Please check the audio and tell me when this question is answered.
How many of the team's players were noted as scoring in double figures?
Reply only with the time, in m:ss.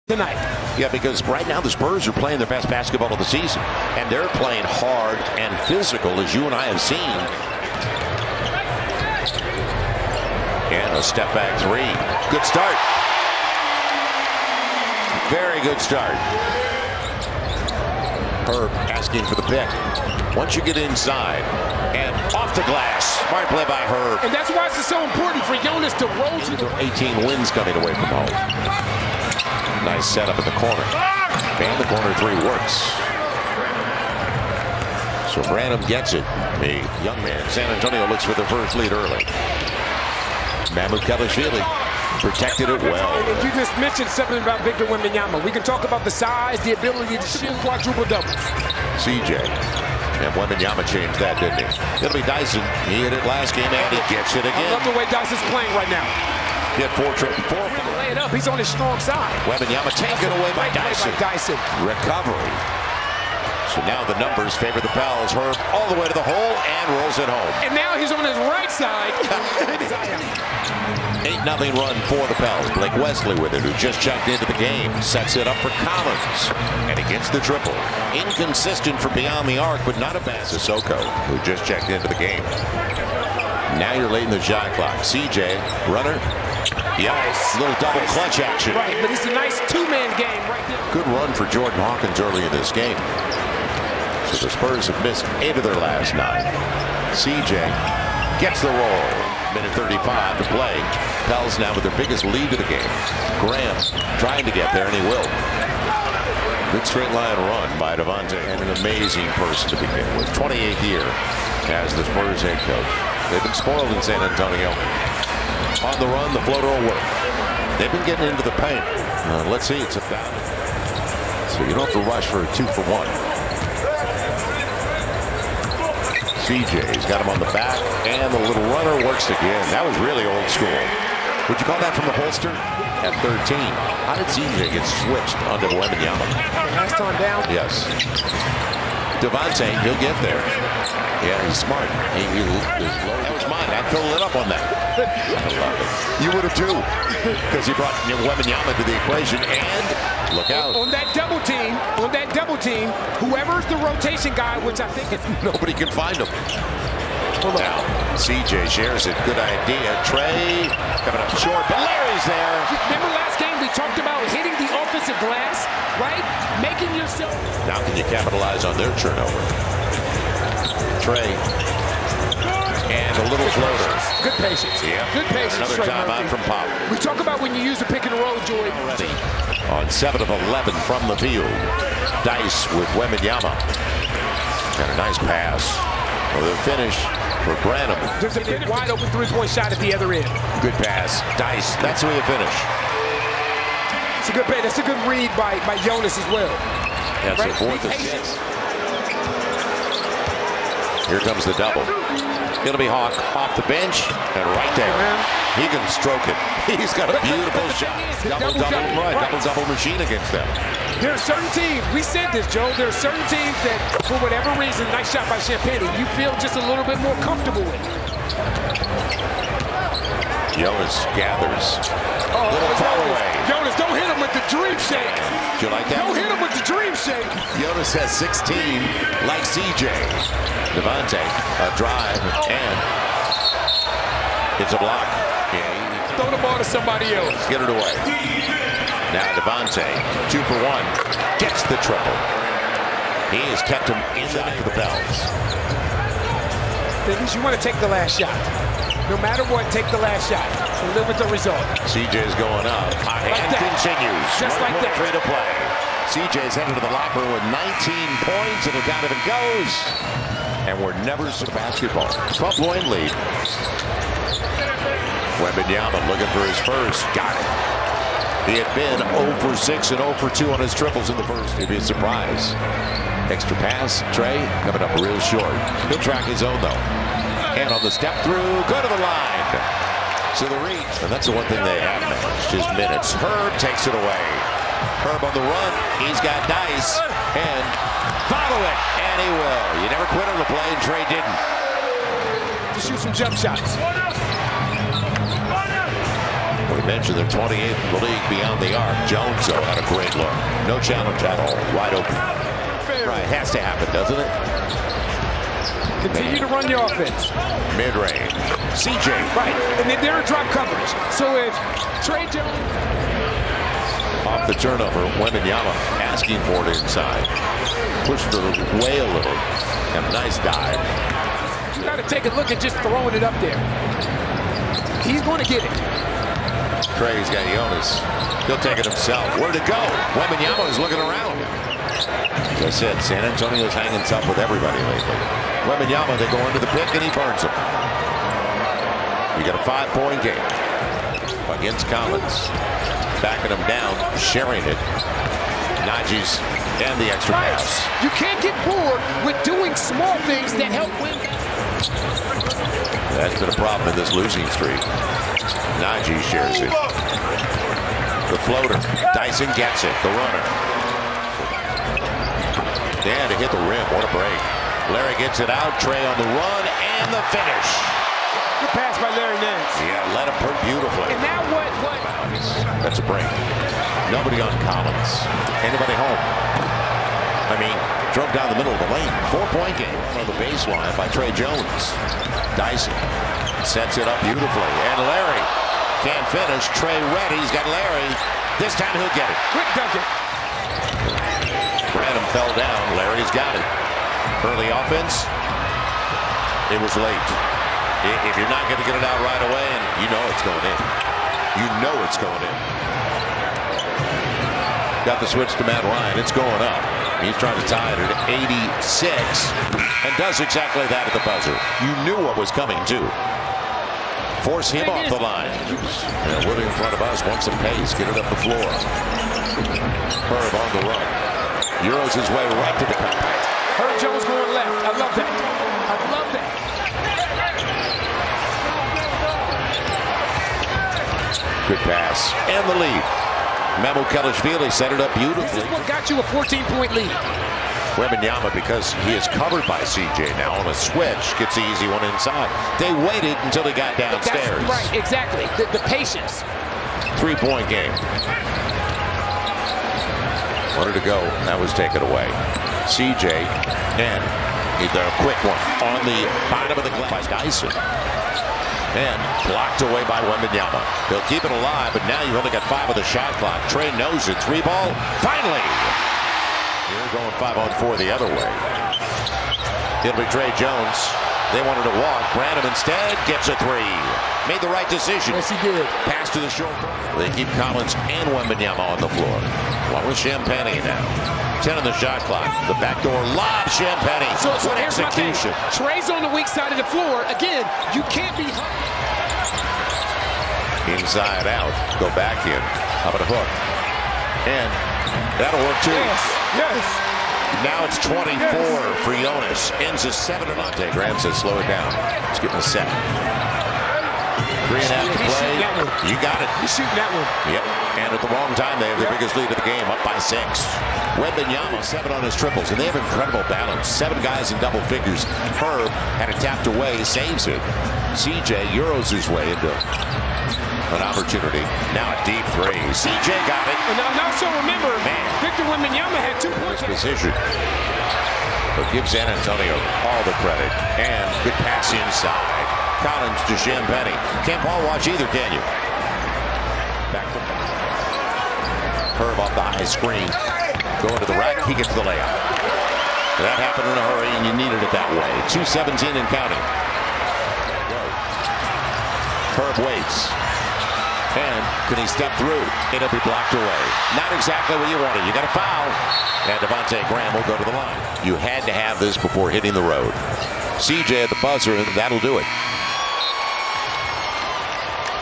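8:33.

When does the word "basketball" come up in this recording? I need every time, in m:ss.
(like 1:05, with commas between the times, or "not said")
0:02, 4:21.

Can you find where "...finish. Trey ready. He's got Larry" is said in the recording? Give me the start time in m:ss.
6:26.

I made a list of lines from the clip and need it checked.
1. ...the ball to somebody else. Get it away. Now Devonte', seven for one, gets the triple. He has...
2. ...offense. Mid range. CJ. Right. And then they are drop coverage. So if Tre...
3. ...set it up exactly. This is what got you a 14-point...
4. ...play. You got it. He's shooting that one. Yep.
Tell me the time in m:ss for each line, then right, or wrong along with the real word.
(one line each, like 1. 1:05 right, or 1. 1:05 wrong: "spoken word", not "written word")
1. 3:56 wrong: "two", not "seven"
2. 5:06 right
3. 7:14 wrong: "beautifully", not "exactly"
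4. 8:25 right.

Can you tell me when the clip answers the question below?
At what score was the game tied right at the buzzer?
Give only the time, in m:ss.
6:48.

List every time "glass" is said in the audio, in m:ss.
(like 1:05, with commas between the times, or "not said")
0:22, 2:45, 7:36.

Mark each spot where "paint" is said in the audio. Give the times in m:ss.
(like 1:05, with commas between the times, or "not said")
1:58.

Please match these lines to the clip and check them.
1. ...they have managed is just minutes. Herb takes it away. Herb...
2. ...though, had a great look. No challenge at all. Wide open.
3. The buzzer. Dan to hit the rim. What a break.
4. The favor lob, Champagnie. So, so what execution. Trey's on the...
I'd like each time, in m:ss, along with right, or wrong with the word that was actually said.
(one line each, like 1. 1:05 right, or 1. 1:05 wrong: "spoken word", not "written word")
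1. 4:41 right
2. 4:59 right
3. 6:00 wrong: "runner", not "buzzer"
4. 8:02 wrong: "backdoor", not "favor".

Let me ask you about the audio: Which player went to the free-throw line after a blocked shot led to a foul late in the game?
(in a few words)
Devonte' Graham.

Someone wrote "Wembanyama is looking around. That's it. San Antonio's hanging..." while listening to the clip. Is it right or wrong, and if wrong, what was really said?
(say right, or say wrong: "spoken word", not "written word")
right.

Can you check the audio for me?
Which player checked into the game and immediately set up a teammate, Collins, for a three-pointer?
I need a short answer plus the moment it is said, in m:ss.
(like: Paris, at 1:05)
Blake Wesley, at 1:12.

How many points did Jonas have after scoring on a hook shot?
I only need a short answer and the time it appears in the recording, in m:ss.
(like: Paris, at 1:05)
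24, at 8:17.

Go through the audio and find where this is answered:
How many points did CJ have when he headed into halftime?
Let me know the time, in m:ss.
4:17.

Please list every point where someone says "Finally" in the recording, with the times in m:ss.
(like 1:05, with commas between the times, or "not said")
7:45.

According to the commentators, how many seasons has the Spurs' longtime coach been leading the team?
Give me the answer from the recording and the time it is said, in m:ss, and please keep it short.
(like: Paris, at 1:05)
28, at 1:50.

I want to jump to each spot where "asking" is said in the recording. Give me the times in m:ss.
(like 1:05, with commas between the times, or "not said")
0:18, 5:16.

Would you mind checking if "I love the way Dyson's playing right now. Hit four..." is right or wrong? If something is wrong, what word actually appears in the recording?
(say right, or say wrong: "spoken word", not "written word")
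right.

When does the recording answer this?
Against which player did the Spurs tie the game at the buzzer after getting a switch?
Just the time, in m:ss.
6:45.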